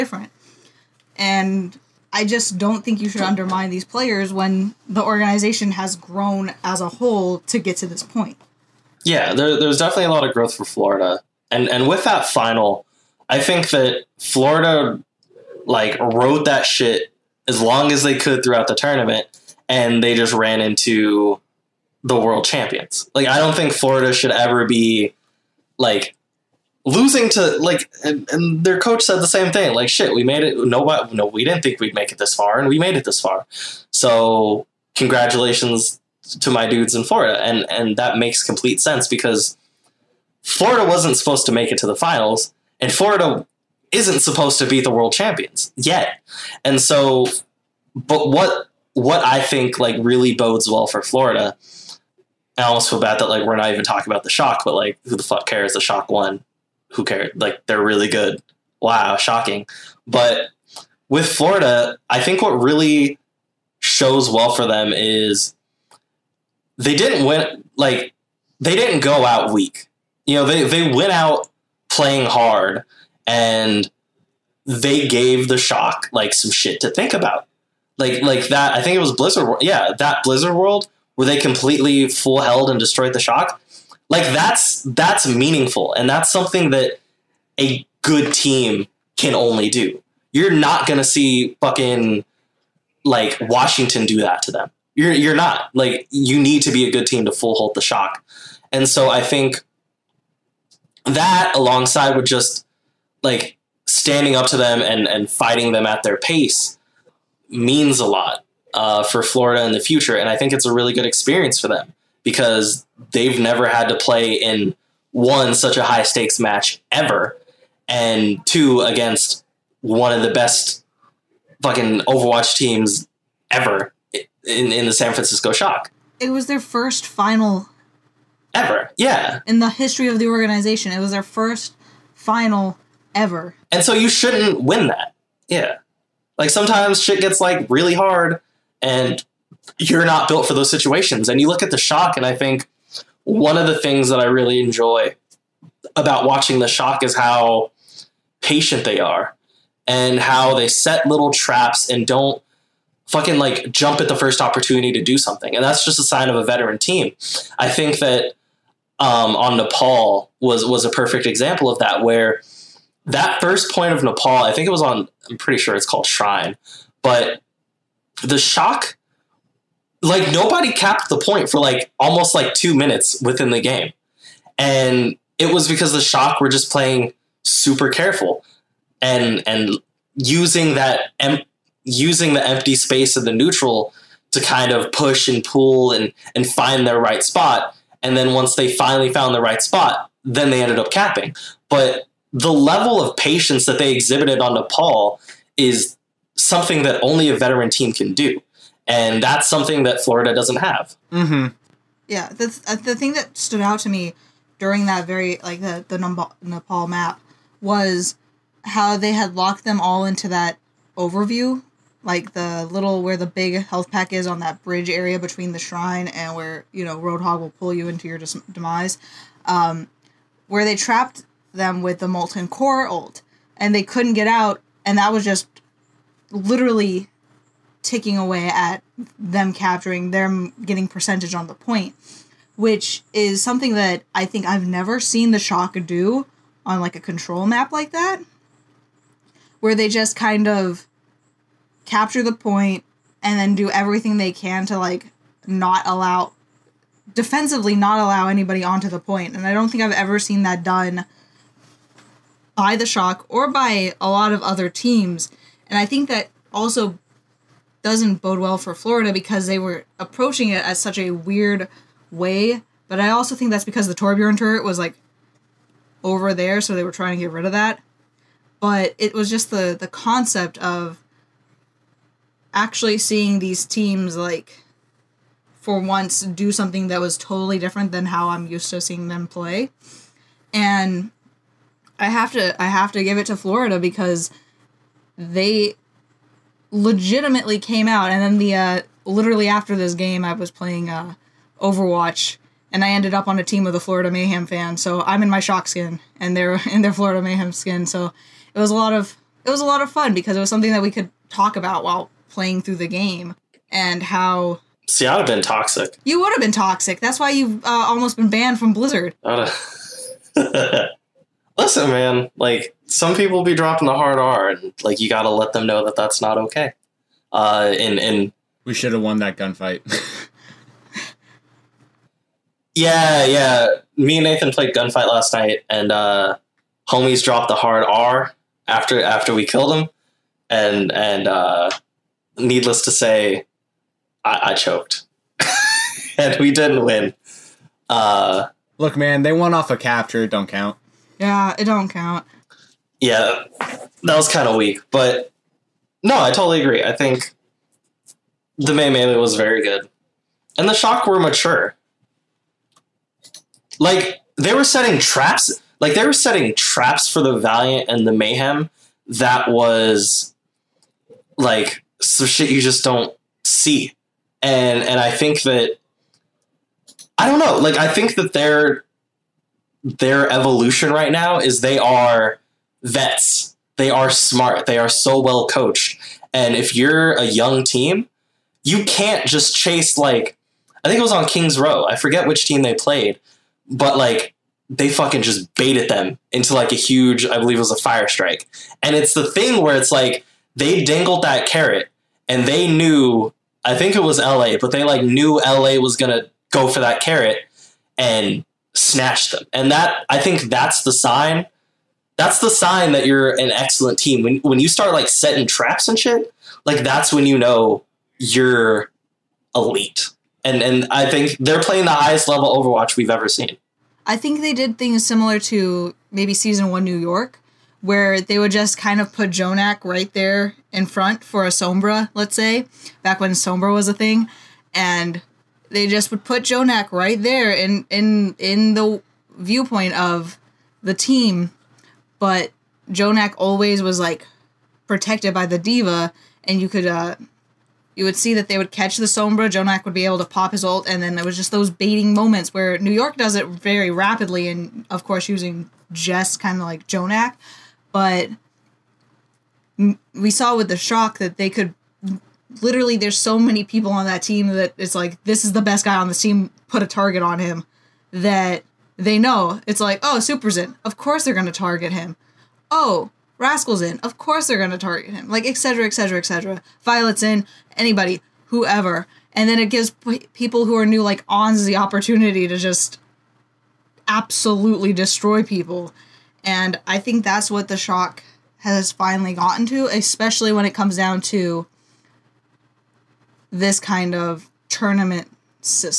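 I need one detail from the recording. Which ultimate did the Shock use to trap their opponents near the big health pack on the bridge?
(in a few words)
molten core.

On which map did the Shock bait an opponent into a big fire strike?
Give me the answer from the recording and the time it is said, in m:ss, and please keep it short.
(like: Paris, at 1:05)
Kings Row, at 6:21.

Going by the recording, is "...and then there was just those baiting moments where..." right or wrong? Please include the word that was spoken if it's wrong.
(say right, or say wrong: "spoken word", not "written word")
right.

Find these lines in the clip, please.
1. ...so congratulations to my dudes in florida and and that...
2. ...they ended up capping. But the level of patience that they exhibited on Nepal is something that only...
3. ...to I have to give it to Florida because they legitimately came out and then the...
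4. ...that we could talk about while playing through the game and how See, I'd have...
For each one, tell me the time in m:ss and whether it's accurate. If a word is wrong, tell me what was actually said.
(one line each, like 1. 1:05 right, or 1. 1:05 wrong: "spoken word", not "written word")
1. 0:33 right
2. 3:10 right
3. 4:42 right
4. 5:00 right.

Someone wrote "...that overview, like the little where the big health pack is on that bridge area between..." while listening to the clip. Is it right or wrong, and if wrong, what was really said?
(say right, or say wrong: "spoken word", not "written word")
right.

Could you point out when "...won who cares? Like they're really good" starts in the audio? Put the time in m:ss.
0:56.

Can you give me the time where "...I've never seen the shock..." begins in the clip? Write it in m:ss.
3:54.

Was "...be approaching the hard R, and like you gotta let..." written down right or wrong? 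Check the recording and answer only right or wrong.
wrong.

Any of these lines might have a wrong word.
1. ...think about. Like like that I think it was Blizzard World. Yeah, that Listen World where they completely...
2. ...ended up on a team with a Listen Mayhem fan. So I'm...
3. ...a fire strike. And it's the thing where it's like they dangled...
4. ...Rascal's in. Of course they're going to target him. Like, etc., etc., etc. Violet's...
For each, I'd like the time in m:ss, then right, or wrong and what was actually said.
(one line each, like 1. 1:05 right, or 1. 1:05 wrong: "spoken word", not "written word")
1. 1:16 wrong: "Blizzard", not "Listen"
2. 4:52 wrong: "Florida", not "Listen"
3. 6:27 right
4. 7:43 right.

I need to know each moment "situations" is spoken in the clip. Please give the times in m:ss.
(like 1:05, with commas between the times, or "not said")
2:20.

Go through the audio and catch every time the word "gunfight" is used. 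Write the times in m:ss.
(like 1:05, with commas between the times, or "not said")
5:19, 5:24.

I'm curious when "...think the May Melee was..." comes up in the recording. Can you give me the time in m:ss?
5:46.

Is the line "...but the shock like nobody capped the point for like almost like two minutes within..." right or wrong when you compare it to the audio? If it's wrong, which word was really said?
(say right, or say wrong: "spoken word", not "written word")
right.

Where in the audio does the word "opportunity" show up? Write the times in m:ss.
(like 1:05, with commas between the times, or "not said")
2:34, 7:51.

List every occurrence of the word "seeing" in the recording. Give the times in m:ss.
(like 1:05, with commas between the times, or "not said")
4:32, 4:38.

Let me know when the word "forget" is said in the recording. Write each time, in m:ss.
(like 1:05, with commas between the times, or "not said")
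6:21.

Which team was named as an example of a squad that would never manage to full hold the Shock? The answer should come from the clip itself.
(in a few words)
Washington.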